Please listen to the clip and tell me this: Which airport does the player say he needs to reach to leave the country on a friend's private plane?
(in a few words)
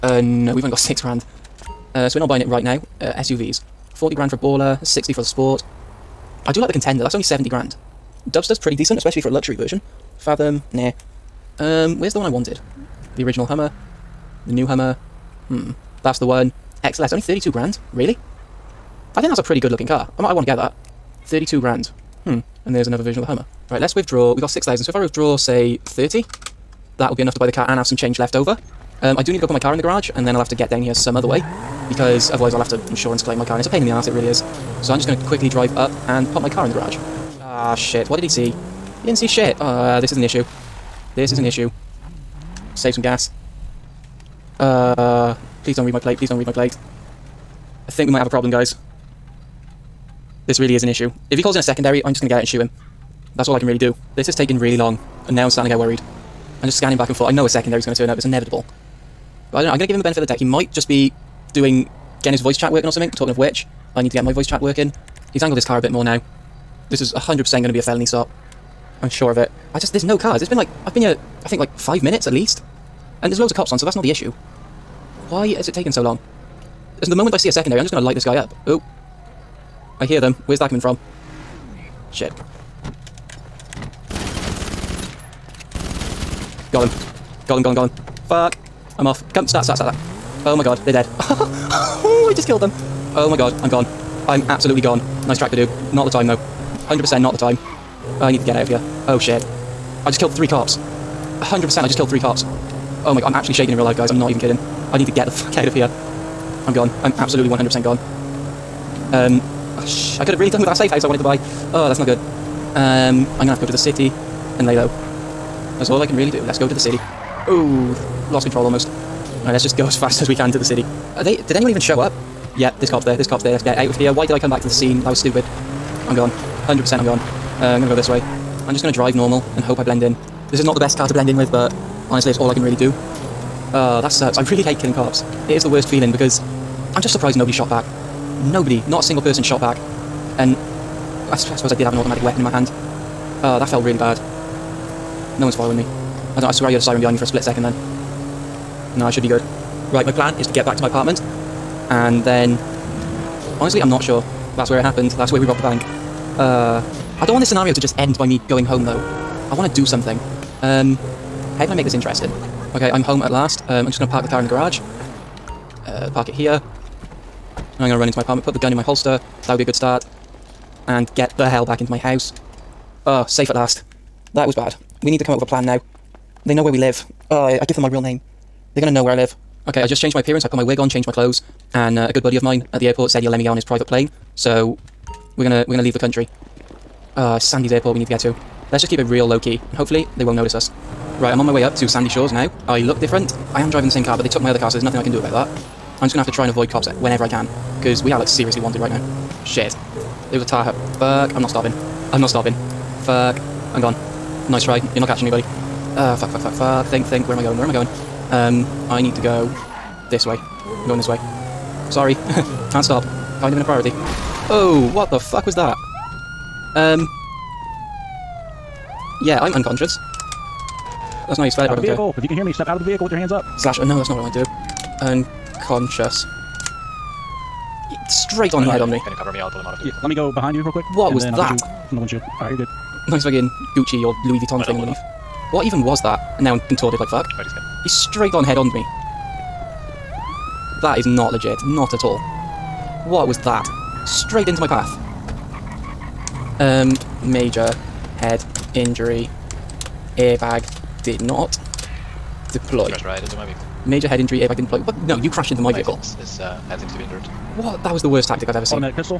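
Sandy's airport.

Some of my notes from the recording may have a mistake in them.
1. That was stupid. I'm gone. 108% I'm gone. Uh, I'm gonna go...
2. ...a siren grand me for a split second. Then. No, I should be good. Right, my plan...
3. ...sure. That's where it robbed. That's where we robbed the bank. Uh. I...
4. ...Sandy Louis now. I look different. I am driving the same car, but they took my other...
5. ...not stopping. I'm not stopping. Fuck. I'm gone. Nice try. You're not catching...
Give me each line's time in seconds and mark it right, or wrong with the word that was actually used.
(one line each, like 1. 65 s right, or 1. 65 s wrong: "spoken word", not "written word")
1. 125 s wrong: "100", not "108"
2. 146 s wrong: "behind", not "grand"
3. 154 s wrong: "happened", not "robbed"
4. 191 s wrong: "Shores", not "Louis"
5. 201 s right.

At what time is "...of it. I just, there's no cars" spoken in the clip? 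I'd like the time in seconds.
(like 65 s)
69 s.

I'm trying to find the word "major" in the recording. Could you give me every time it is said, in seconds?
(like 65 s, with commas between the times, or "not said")
247 s, 253 s.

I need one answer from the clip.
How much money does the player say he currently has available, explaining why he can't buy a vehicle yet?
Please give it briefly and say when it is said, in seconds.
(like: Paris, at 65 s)
6 grand, at 0 s.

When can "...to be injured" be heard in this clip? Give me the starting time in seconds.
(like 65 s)
256 s.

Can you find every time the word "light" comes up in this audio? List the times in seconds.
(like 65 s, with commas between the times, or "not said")
78 s.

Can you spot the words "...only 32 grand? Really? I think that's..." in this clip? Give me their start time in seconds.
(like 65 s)
17 s.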